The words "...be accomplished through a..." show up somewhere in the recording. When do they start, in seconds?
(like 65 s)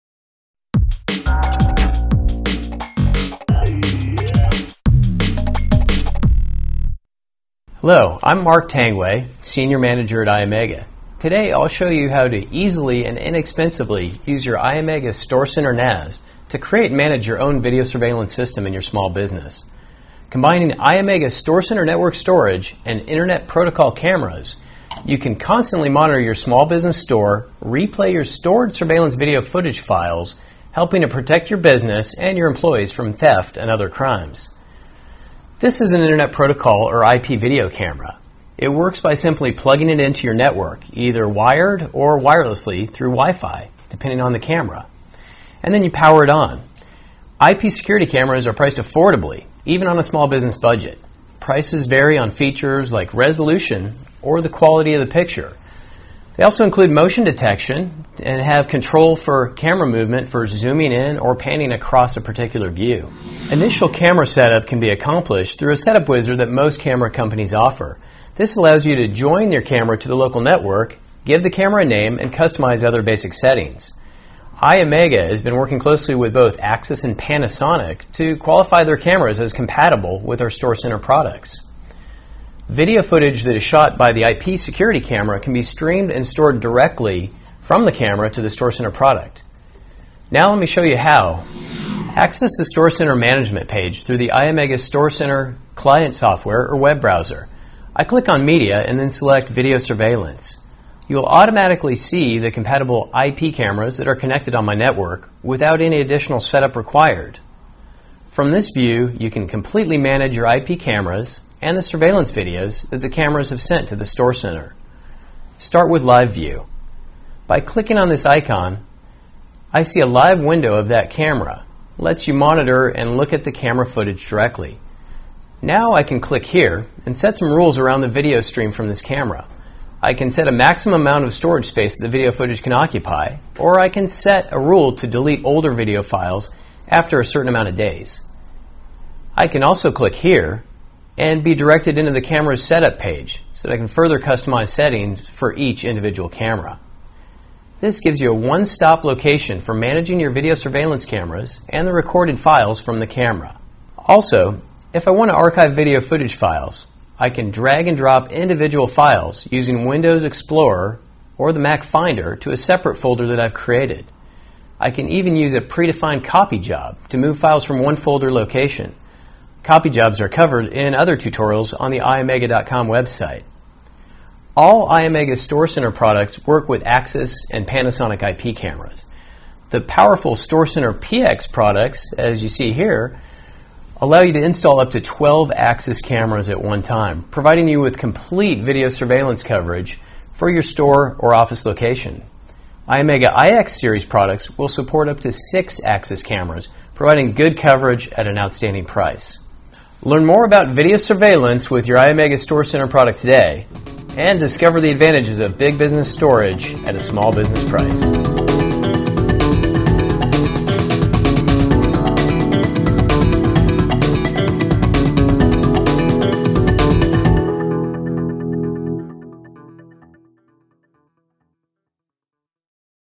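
64 s.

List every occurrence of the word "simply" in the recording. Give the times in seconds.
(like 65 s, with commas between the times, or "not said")
39 s.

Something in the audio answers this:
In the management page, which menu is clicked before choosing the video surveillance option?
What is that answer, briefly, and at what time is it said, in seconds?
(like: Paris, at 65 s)
Media, at 98 s.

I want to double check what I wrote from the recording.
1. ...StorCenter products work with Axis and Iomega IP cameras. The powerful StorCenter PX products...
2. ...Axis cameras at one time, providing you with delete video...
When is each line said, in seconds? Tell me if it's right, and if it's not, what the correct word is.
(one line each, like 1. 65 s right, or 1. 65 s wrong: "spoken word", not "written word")
1. 175 s wrong: "Panasonic", not "Iomega"
2. 185 s wrong: "complete", not "delete".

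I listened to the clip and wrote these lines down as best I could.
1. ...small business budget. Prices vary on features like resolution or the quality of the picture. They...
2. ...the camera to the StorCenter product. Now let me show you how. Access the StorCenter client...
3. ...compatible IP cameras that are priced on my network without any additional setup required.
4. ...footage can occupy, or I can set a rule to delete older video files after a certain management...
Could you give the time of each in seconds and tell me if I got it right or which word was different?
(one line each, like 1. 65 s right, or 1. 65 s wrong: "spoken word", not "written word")
1. 50 s right
2. 87 s wrong: "management", not "client"
3. 102 s wrong: "connected", not "priced"
4. 132 s wrong: "amount", not "management".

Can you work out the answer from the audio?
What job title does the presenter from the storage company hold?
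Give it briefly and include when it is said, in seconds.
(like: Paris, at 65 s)
Senior Manager, at 9 s.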